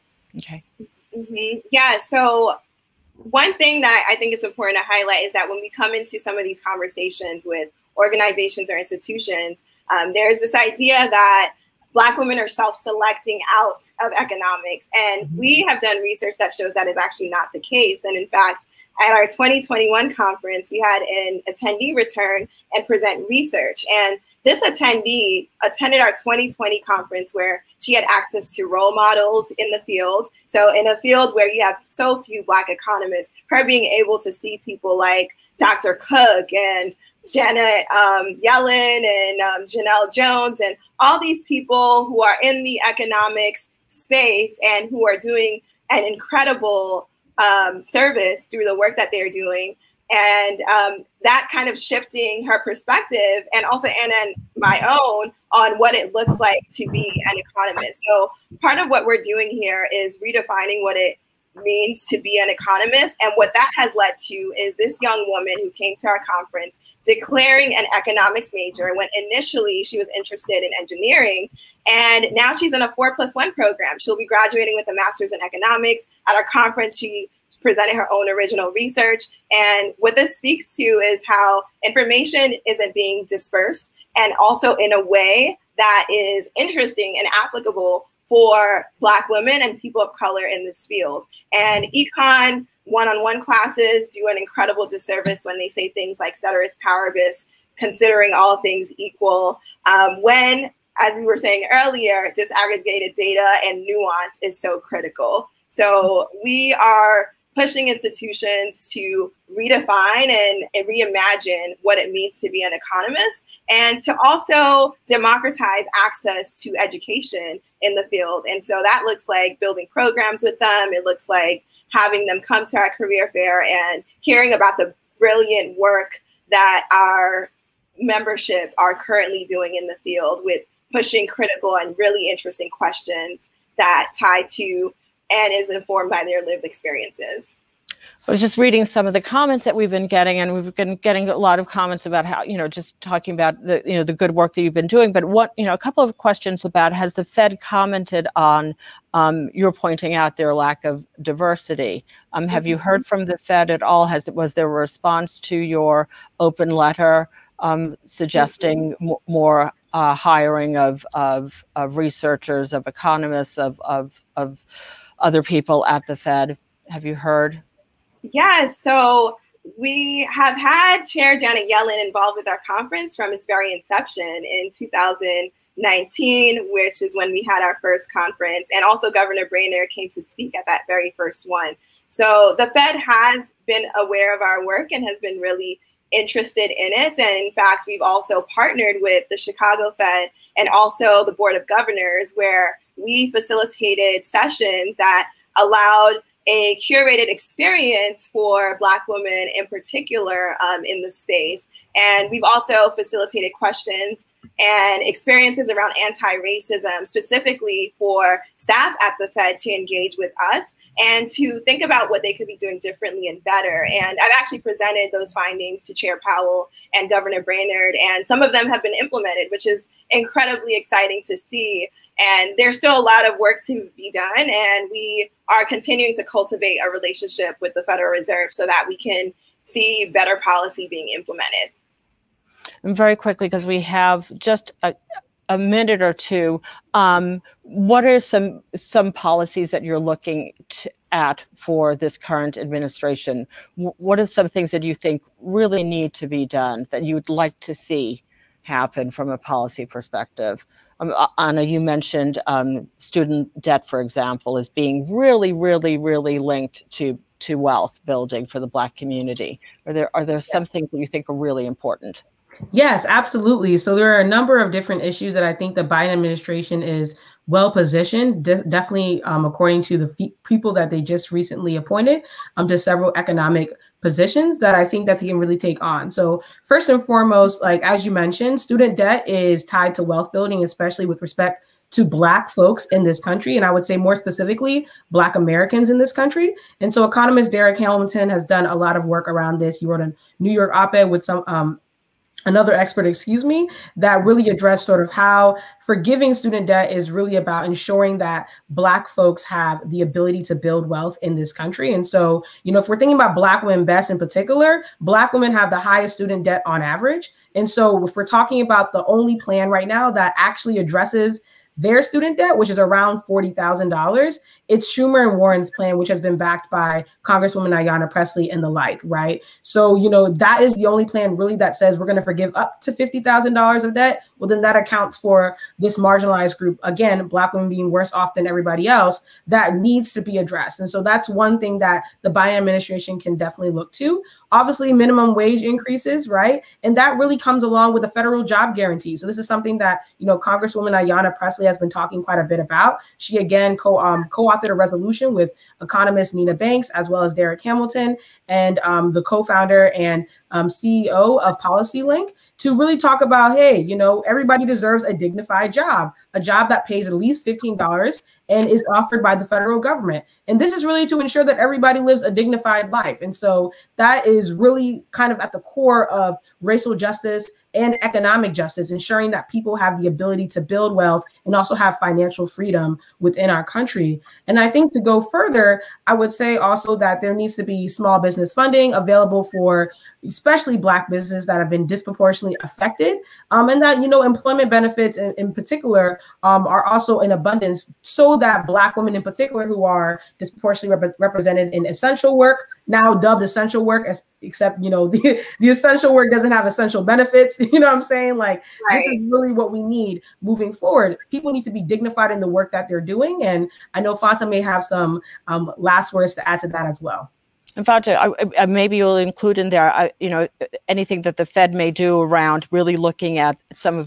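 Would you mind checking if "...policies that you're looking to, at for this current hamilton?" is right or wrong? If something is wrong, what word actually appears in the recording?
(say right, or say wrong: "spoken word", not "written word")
wrong: "administration", not "hamilton".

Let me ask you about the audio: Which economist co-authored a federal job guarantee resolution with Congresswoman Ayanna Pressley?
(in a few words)
Nina Banks.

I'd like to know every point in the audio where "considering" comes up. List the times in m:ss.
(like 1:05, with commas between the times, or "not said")
1:37.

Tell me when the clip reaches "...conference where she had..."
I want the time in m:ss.
0:26.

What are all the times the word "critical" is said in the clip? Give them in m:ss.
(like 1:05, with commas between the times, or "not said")
1:44, 2:11.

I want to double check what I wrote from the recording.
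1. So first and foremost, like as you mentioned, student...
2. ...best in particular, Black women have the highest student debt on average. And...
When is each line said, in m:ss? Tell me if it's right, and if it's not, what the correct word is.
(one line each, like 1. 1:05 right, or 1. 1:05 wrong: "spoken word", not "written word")
1. 4:36 right
2. 5:03 right.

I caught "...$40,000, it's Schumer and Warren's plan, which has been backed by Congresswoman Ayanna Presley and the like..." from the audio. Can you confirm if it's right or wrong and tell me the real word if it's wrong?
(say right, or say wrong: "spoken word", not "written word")
right.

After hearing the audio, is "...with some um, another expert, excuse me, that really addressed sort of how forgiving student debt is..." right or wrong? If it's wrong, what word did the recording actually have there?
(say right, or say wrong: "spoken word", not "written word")
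right.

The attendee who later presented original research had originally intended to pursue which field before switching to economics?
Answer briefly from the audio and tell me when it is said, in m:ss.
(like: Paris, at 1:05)
Engineering, at 1:10.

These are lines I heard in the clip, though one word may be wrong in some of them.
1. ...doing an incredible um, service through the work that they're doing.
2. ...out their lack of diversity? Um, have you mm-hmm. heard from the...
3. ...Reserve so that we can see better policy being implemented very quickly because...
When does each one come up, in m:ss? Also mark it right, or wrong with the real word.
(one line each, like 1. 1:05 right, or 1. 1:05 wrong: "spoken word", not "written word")
1. 0:45 right
2. 2:30 right
3. 3:48 right.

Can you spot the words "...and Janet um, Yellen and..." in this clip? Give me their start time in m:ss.
0:36.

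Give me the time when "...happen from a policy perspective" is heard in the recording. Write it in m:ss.
4:08.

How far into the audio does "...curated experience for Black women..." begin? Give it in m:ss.
3:16.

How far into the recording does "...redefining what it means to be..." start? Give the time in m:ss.
1:00.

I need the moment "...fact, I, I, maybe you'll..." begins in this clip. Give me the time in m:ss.
6:47.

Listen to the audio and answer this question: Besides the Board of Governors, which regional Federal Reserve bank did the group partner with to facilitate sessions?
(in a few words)
Chicago Fed.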